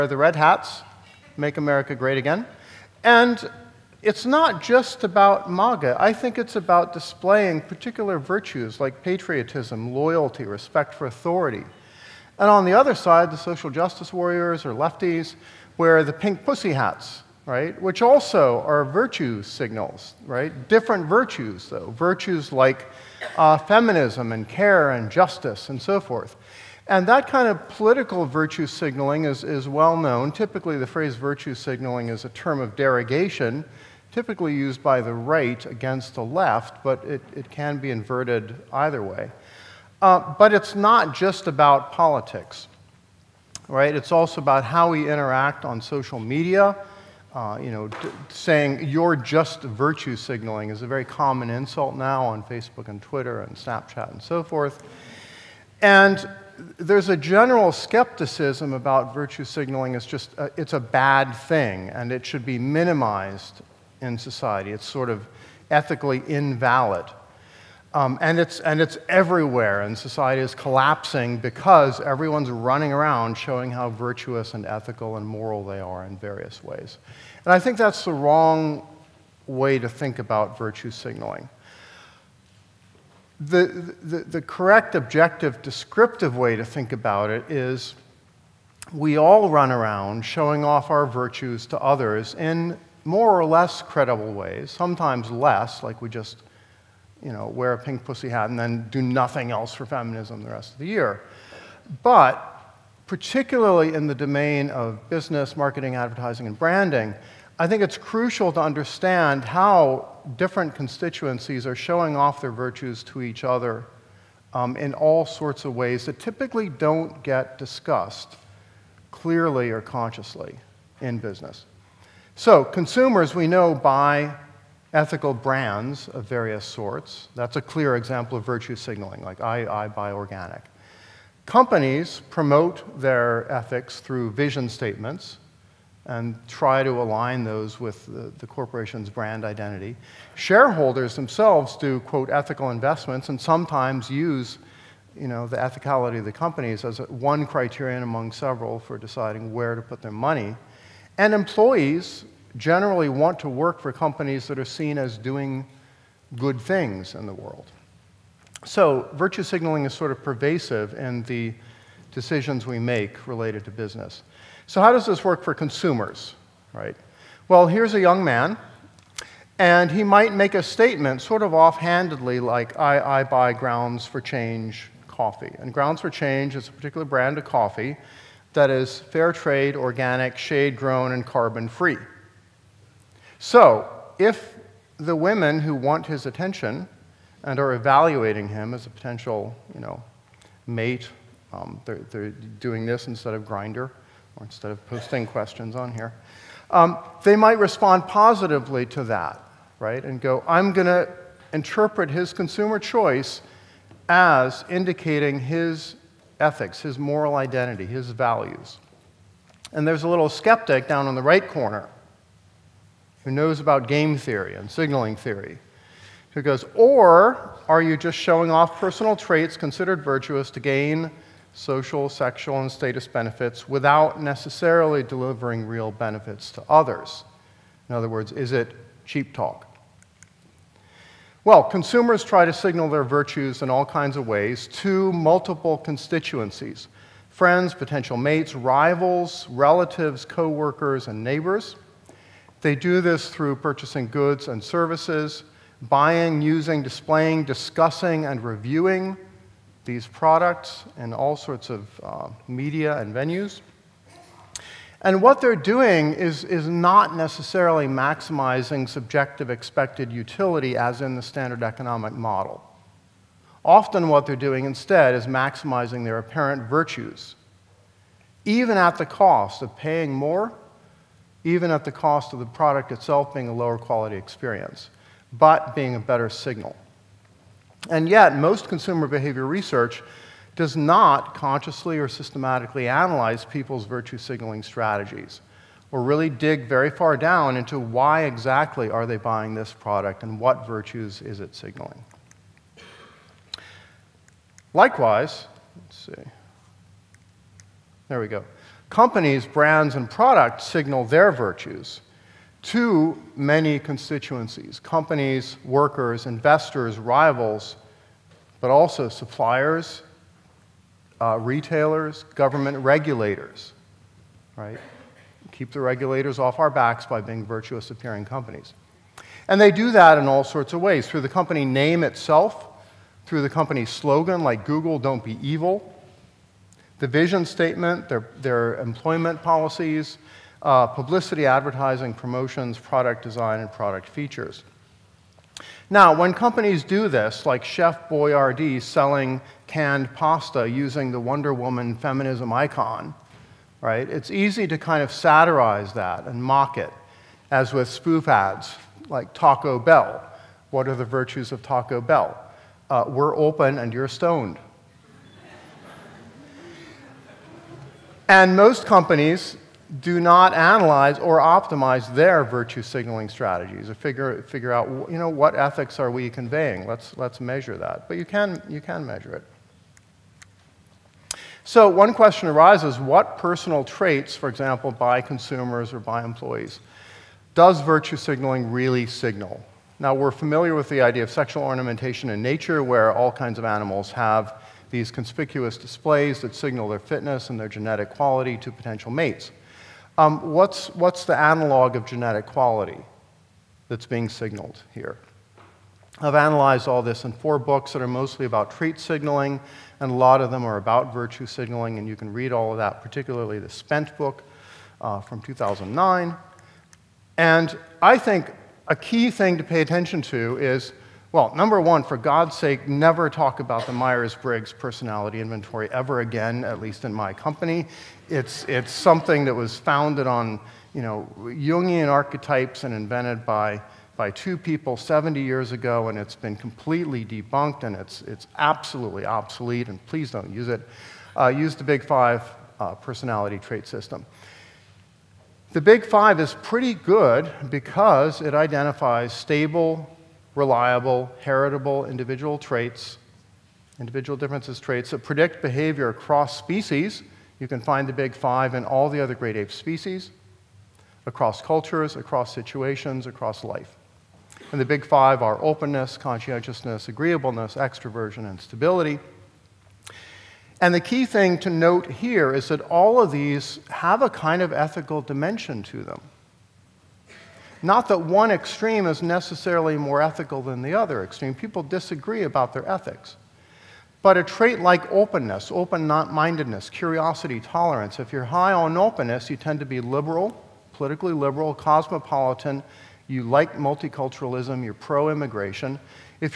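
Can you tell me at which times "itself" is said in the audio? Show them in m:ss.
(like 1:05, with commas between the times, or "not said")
4:32, 5:22.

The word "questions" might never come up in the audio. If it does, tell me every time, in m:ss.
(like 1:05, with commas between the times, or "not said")
3:15, 6:12.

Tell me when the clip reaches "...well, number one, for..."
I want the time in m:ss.
6:51.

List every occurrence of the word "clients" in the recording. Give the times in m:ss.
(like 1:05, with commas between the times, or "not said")
not said.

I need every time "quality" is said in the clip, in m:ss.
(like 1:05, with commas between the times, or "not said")
4:33, 6:28, 6:32.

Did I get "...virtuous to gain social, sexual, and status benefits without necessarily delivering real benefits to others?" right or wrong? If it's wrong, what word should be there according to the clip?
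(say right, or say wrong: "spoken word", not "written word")
right.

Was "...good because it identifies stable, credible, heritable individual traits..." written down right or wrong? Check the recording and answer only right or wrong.
wrong.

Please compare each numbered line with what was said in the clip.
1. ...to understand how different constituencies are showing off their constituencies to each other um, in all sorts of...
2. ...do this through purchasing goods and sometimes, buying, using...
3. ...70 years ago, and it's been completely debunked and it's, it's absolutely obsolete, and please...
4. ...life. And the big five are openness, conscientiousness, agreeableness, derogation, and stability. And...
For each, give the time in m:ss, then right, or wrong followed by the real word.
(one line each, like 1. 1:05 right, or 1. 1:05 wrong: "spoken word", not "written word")
1. 1:48 wrong: "virtues", not "constituencies"
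2. 4:02 wrong: "services", not "sometimes"
3. 7:04 right
4. 7:33 wrong: "extroversion", not "derogation".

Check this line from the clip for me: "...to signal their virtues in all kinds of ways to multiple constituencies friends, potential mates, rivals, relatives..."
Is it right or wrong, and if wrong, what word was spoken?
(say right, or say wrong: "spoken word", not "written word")
right.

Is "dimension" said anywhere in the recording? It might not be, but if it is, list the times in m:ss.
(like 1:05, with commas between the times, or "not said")
7:45.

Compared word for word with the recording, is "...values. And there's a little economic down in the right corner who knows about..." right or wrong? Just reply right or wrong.
wrong.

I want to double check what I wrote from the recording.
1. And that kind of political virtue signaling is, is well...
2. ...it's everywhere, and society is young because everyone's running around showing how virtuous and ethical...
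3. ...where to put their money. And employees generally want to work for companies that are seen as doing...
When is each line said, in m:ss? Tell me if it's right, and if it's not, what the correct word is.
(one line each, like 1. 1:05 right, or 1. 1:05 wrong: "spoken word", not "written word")
1. 0:26 right
2. 1:08 wrong: "collapsing", not "young"
3. 2:29 right.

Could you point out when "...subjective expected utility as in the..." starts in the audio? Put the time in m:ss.
4:18.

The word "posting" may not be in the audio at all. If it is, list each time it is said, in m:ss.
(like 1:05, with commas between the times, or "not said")
3:14.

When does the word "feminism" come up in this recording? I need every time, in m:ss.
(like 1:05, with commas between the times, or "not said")
0:23, 1:39, 5:41.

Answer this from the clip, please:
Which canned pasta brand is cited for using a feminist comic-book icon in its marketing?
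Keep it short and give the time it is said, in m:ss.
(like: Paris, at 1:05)
Chef Boyardee, at 5:37.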